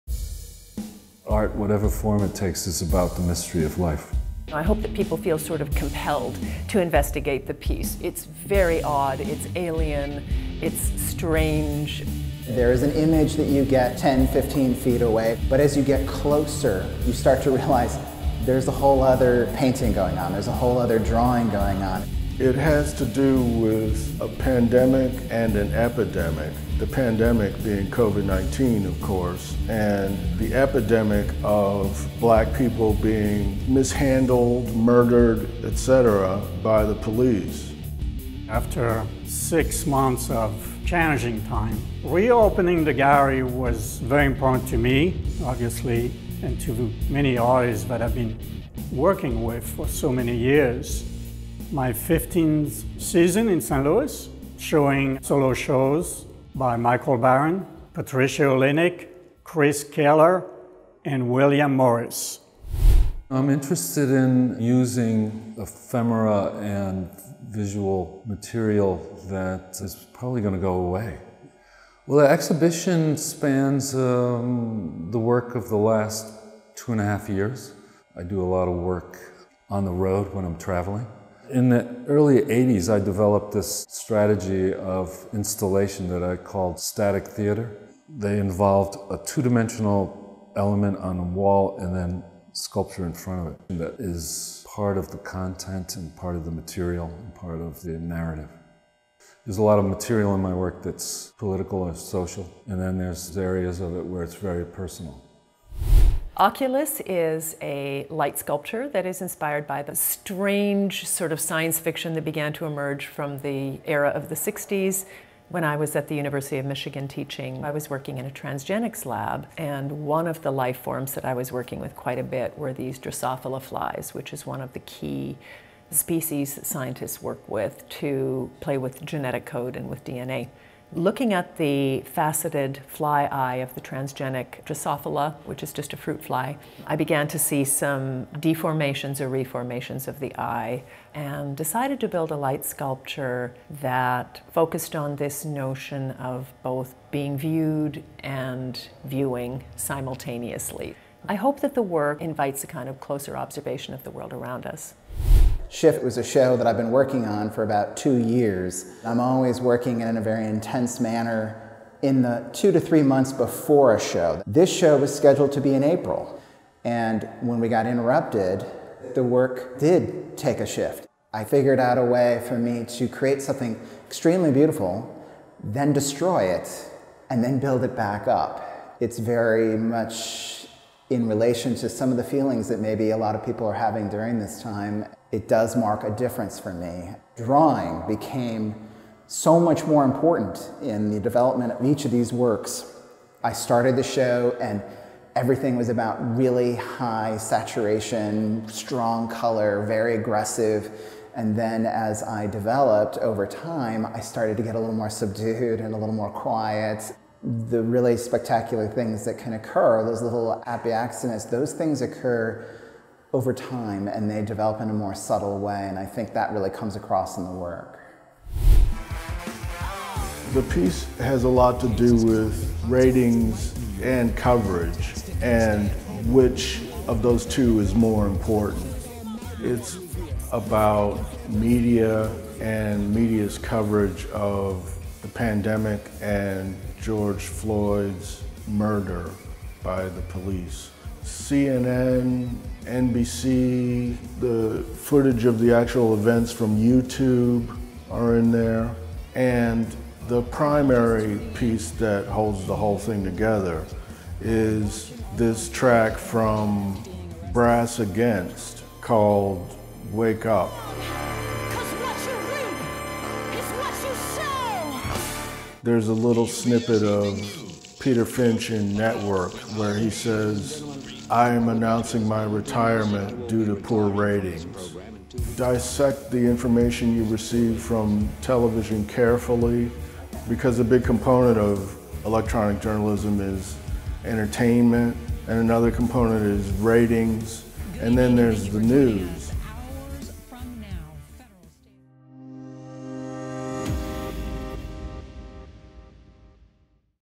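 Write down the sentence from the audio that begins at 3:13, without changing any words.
I started the show and everything was about really high saturation, strong color, very aggressive.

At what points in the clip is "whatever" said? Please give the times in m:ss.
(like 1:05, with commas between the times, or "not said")
0:01.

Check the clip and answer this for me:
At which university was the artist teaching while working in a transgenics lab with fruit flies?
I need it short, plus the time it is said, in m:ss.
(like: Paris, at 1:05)
University of Michigan, at 1:56.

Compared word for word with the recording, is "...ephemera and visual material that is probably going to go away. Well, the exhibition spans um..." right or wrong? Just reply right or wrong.
right.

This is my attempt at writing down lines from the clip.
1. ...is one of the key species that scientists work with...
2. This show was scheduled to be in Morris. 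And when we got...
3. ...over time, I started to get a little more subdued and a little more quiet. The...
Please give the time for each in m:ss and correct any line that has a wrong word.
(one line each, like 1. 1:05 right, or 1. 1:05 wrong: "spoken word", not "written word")
1. 2:04 right
2. 2:44 wrong: "April", not "Morris"
3. 3:23 right.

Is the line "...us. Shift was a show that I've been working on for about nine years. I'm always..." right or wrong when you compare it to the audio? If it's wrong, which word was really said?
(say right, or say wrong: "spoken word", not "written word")
wrong: "two", not "nine".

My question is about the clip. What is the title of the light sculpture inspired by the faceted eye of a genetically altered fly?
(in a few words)
Oculus.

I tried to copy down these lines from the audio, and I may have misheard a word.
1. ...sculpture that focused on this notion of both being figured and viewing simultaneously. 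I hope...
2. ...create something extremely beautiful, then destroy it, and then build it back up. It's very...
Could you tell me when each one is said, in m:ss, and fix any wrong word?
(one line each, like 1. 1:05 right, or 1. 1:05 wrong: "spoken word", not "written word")
1. 2:22 wrong: "viewed", not "figured"
2. 2:53 right.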